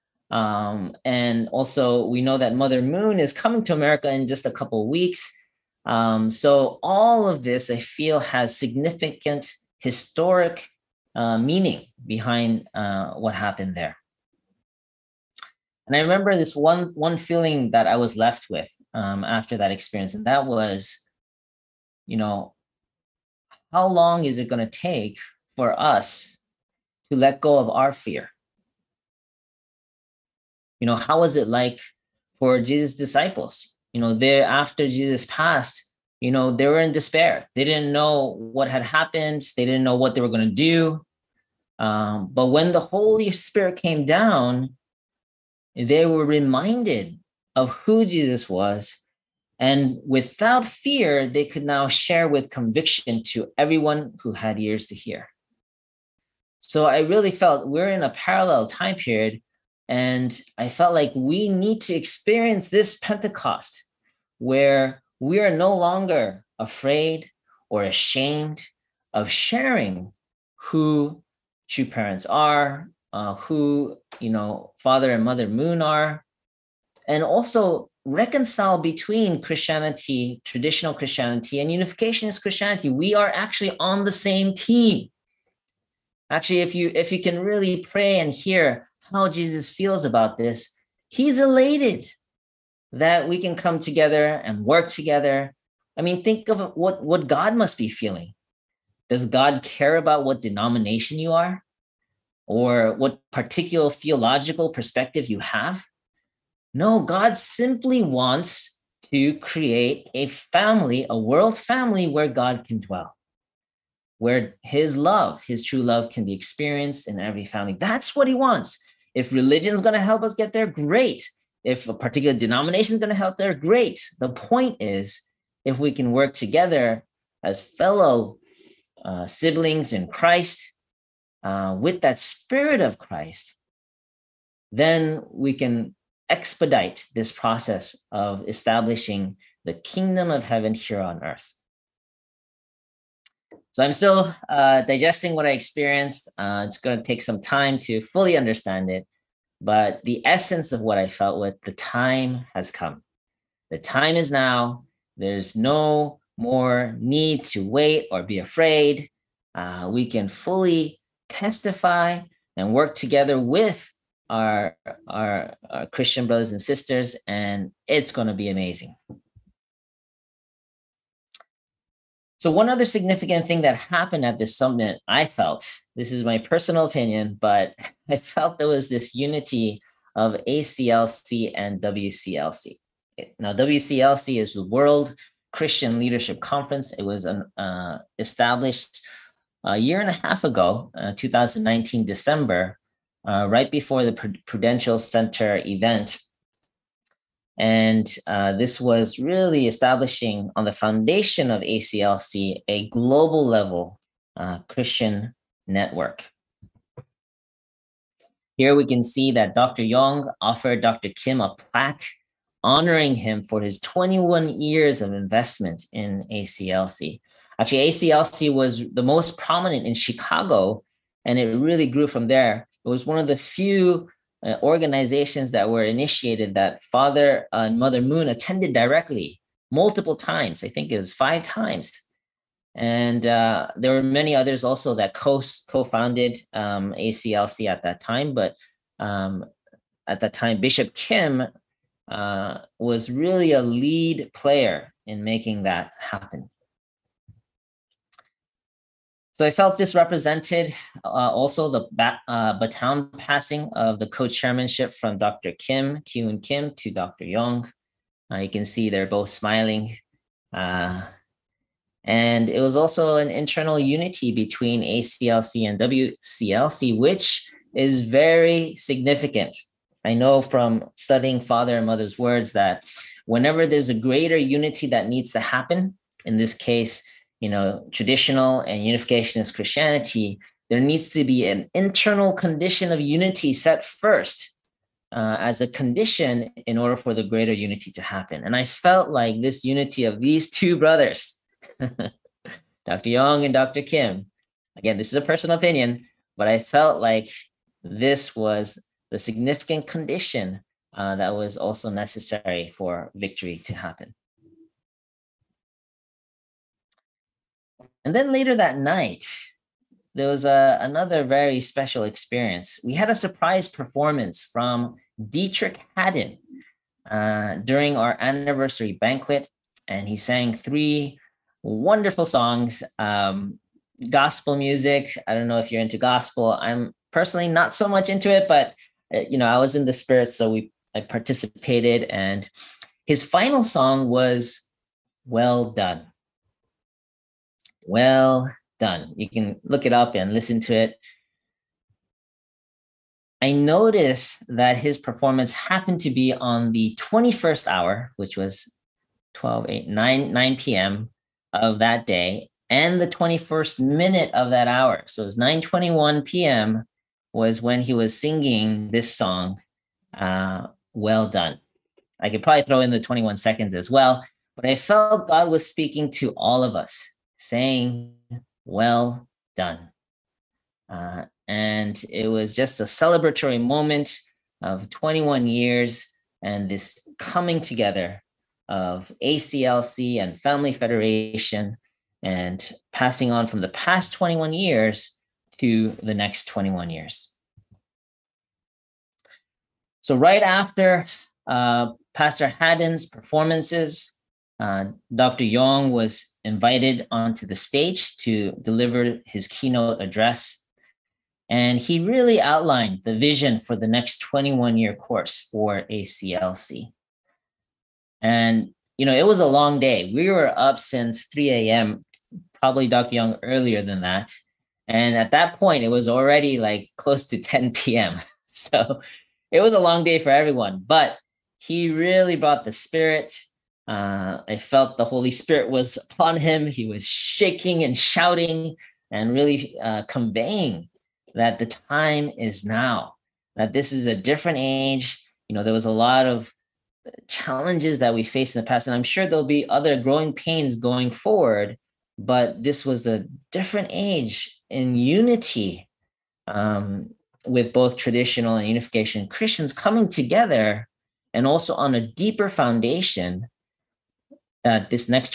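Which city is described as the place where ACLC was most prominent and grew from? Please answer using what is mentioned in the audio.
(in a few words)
Chicago.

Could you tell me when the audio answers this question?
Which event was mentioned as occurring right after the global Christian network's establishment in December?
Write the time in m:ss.
3:14.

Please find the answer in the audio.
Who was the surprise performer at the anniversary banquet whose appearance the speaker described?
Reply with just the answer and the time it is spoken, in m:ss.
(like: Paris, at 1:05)
Deitrick Haddon, at 5:15.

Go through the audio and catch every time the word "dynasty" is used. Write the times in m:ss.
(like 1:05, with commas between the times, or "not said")
not said.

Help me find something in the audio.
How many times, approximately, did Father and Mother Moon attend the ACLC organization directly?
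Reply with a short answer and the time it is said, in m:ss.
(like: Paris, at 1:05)
5, at 3:51.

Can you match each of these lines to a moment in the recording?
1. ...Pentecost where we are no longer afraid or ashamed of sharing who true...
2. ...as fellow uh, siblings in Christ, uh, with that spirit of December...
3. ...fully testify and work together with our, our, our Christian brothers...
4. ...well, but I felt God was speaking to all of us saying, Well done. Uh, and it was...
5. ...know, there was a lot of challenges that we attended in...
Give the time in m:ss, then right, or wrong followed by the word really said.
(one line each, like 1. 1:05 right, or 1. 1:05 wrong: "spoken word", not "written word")
1. 1:02 right
2. 2:07 wrong: "Christ", not "December"
3. 2:40 right
4. 6:03 right
5. 7:15 wrong: "faced", not "attended".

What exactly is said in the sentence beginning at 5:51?
of that day, and the 21st minute of that hour.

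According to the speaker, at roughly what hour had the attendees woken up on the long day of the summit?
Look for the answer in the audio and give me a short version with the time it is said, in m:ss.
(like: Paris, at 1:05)
3 a.m., at 6:51.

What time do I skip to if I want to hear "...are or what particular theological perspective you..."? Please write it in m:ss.
1:41.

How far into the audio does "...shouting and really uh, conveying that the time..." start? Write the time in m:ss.
7:07.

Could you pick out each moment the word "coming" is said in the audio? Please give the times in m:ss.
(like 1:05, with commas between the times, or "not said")
0:03, 6:17, 7:29.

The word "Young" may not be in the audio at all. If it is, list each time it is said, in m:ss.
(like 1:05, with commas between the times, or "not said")
3:29, 4:17, 4:53, 6:35, 6:53.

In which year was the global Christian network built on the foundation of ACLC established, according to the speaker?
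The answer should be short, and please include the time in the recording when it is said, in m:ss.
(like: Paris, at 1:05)
2019, at 3:11.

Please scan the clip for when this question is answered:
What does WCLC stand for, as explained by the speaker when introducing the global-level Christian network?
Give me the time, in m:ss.
3:04.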